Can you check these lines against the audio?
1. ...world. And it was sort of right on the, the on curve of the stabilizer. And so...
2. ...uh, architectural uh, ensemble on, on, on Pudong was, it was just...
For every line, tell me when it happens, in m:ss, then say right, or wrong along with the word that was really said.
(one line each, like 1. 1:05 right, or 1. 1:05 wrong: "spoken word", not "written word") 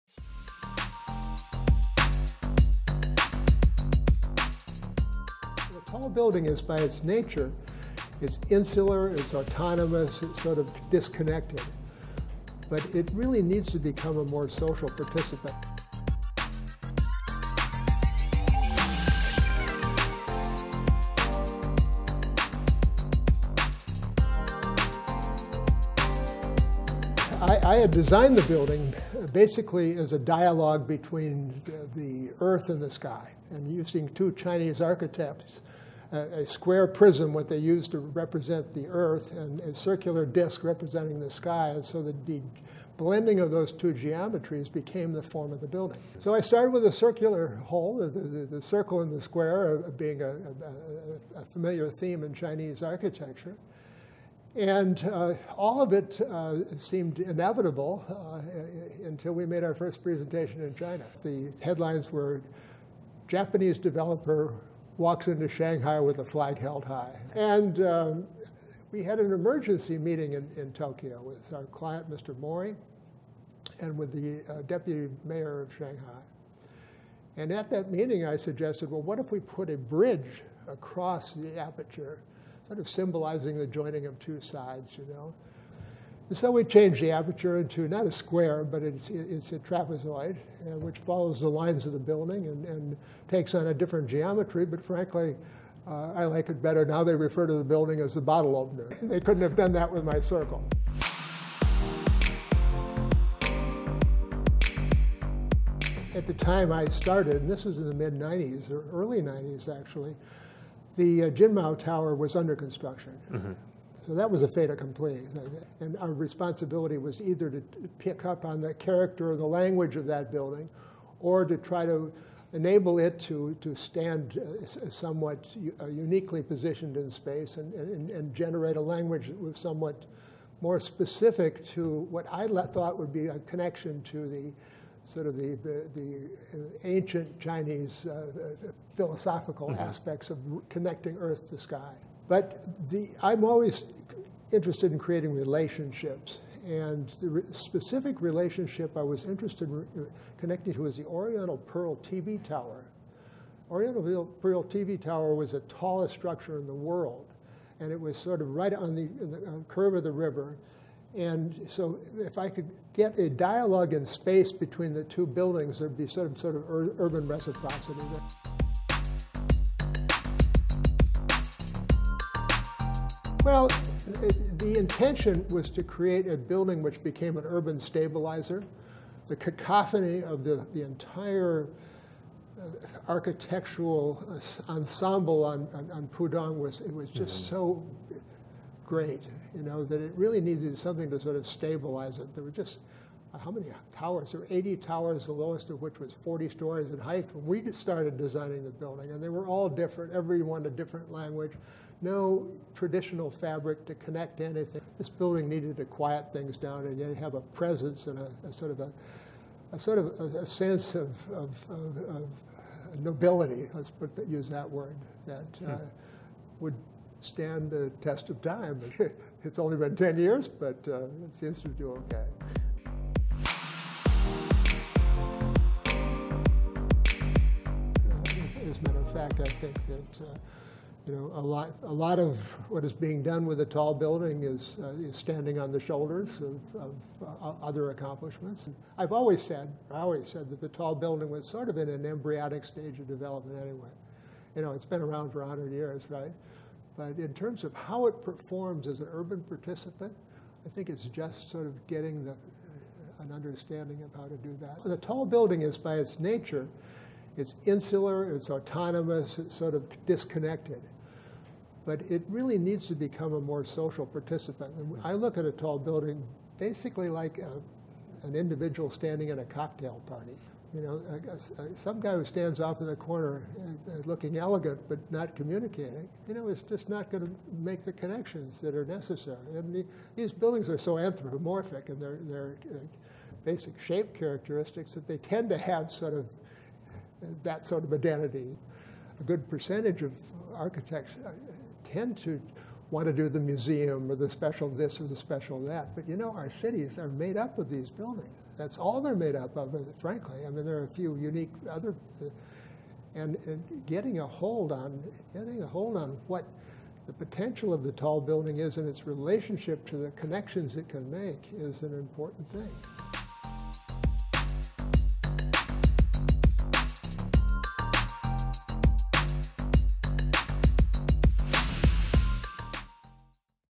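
1. 2:36 wrong: "river", not "stabilizer"
2. 3:02 right.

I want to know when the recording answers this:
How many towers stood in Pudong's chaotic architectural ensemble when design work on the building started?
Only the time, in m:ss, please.
3:14.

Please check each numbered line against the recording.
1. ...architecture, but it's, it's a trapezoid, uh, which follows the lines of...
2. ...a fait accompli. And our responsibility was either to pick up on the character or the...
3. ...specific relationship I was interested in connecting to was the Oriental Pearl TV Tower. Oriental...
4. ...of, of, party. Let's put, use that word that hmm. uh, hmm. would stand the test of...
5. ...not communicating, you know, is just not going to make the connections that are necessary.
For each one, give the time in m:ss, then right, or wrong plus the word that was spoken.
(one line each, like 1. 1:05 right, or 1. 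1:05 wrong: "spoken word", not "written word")
1. 1:28 wrong: "square", not "architecture"
2. 1:54 right
3. 2:27 right
4. 3:31 wrong: "nobility", not "party"
5. 4:35 right.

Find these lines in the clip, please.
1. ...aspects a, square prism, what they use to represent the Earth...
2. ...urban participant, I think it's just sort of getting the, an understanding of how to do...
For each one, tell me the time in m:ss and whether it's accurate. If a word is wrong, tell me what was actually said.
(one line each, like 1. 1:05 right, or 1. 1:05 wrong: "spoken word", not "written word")
1. 0:34 wrong: "architects", not "aspects"
2. 4:09 right.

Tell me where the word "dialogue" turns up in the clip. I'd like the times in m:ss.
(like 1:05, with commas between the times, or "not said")
0:30, 2:43.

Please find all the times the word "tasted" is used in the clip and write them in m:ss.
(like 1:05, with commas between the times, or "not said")
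not said.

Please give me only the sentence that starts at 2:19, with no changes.
aspects of connecting Earth to sky.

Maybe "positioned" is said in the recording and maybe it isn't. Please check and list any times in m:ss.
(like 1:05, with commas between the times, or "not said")
2:06.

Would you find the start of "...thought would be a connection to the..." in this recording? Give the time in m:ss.
2:12.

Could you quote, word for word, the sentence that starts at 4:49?
A good percentage of architects uh, tend to want to do the museum or the special this or the special that.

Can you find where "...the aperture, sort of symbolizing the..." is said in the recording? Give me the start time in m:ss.
1:21.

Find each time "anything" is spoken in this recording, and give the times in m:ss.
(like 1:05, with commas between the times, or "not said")
3:24.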